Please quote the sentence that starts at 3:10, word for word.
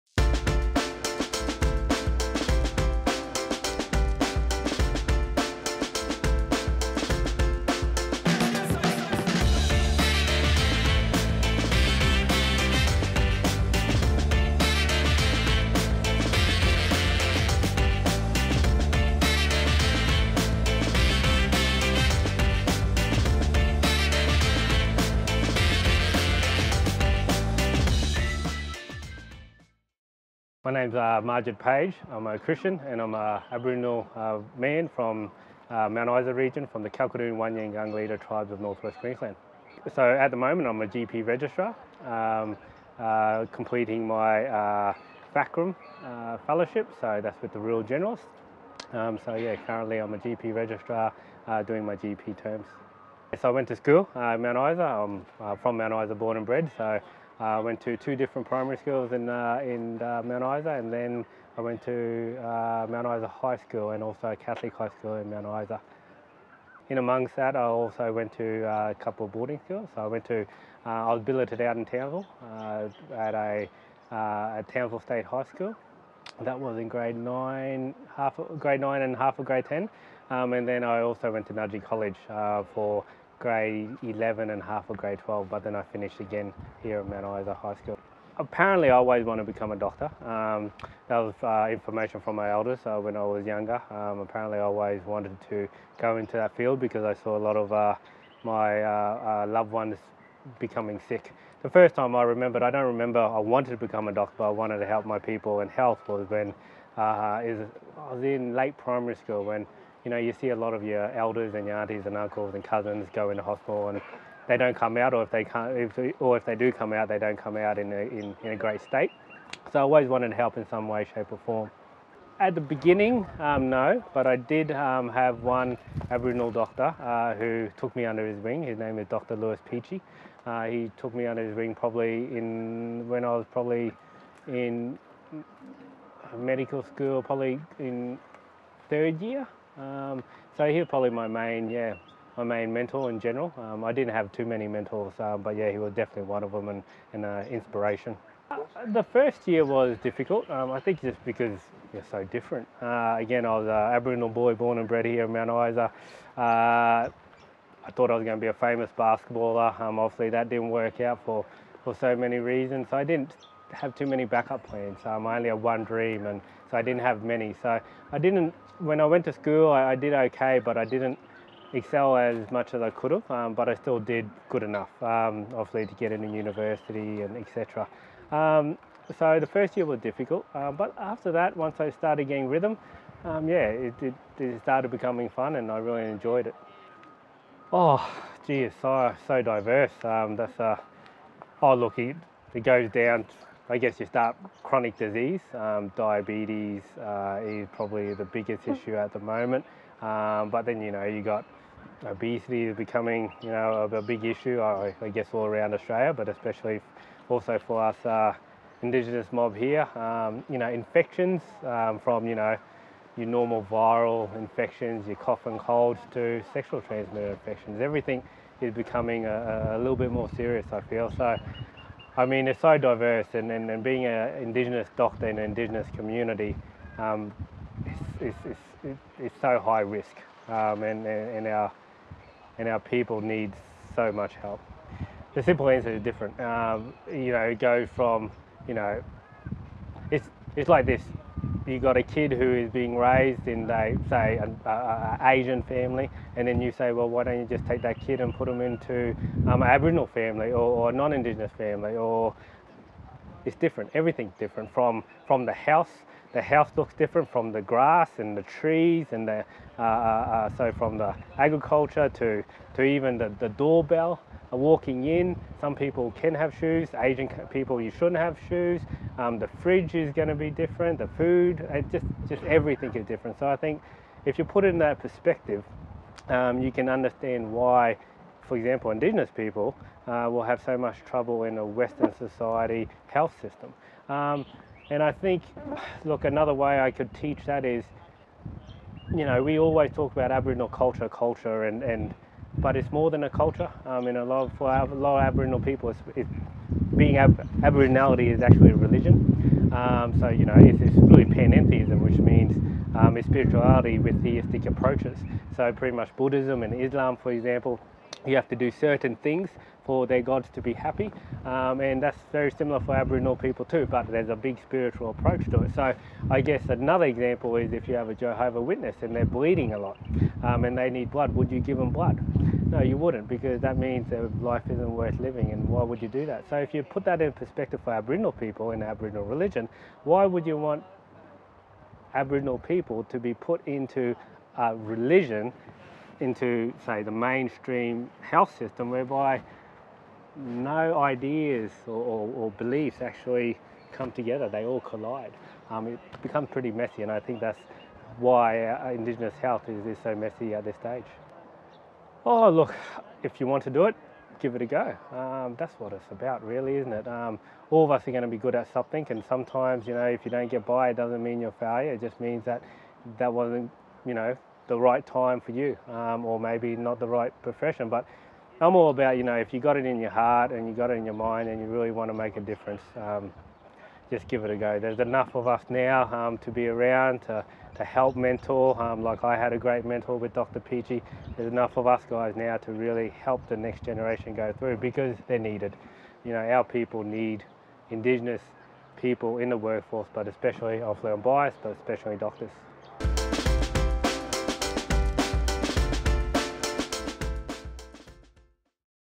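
Um, that's a, uh, oh, look, it, it goes down I guess you start chronic disease.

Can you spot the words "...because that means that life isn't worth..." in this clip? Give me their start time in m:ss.
5:23.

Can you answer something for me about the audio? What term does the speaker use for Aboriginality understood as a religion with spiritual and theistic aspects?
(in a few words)
Panentheism.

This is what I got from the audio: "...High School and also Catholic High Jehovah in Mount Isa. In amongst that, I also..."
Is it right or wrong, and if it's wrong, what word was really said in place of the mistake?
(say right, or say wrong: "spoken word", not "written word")
wrong: "School", not "Jehovah".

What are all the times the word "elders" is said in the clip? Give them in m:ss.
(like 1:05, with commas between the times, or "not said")
1:32, 1:51.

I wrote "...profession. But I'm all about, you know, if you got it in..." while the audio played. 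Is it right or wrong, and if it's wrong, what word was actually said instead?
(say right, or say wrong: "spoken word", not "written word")
right.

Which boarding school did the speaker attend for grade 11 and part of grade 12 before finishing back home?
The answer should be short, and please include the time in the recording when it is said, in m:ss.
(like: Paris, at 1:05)
Nudgee College, at 1:21.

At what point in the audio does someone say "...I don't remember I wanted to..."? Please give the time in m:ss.
1:42.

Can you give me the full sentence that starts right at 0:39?
So at the moment I'm a GP registrar, um, uh, completing my uh, uh fellowship, so that's with the Rural Generalist.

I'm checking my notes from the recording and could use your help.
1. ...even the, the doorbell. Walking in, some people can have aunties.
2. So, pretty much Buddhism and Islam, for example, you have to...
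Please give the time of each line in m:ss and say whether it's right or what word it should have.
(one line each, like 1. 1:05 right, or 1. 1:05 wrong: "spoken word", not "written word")
1. 4:22 wrong: "shoes", not "aunties"
2. 5:05 right.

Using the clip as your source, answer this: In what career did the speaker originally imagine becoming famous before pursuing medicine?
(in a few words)
Basketballer.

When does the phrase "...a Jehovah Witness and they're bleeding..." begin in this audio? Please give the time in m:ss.
5:18.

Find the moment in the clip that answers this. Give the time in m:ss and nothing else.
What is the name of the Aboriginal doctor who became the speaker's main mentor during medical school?
2:09.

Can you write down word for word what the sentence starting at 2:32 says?
Uh, again, I was an Aboriginal boy born and bred here in Mount Isa.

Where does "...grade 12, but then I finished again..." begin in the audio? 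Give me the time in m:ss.
1:24.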